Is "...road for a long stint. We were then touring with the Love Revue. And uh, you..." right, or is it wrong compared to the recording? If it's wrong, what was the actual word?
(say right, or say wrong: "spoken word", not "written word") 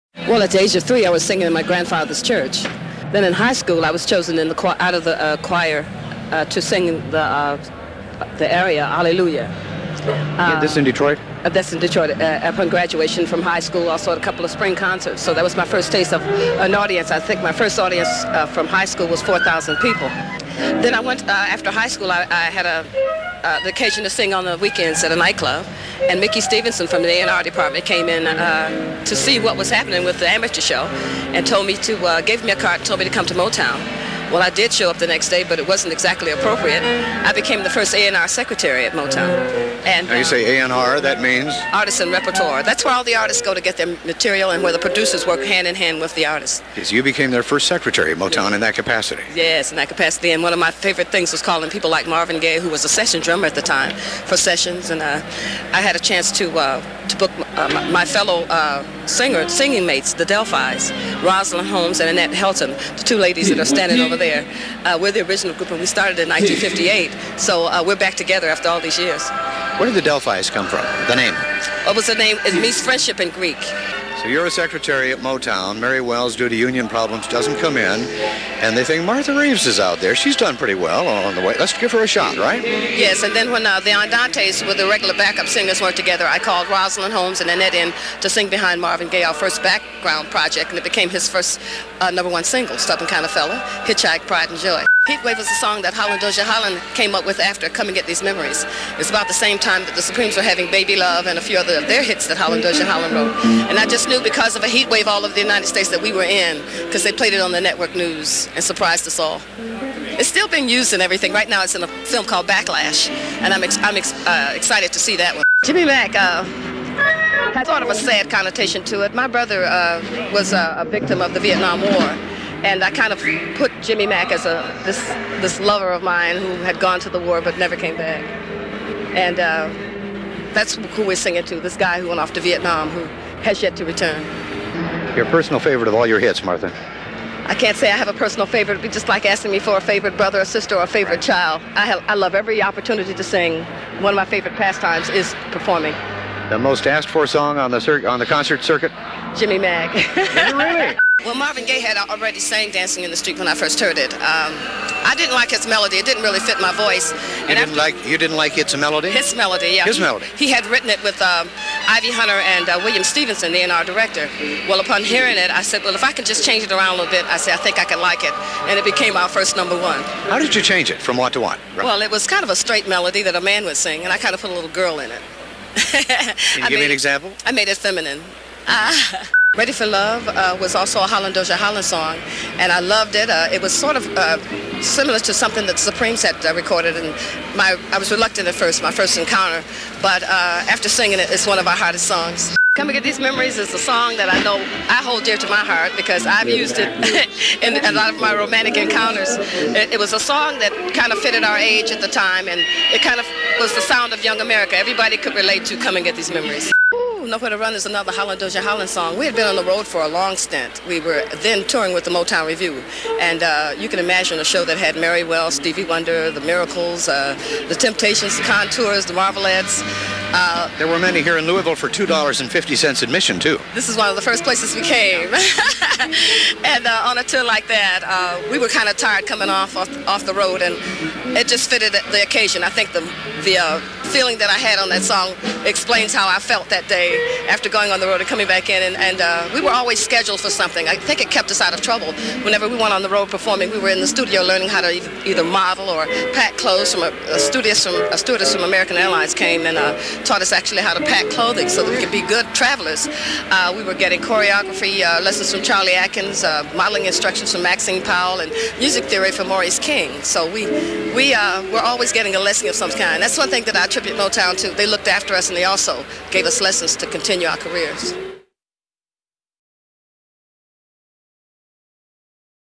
wrong: "Motown", not "Love".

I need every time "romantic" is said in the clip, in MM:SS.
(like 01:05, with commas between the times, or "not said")
03:18.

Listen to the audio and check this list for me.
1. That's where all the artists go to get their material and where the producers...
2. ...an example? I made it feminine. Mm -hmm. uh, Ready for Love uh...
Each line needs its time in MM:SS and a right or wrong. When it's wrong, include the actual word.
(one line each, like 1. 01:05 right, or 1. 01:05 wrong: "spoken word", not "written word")
1. 00:42 right
2. 02:56 right.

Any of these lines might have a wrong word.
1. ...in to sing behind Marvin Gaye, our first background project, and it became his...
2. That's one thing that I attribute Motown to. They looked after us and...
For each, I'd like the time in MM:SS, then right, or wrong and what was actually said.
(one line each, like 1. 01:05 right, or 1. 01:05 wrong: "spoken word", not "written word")
1. 01:27 right
2. 04:23 right.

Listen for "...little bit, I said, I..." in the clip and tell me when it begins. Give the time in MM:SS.
02:46.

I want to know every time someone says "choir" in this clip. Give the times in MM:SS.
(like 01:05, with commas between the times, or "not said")
00:05.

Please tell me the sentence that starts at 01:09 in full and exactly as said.
Where did the Del-Phi's come from?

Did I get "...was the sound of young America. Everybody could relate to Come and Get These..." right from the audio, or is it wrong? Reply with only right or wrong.
right.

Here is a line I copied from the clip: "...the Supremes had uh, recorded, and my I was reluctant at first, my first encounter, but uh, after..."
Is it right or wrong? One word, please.
right.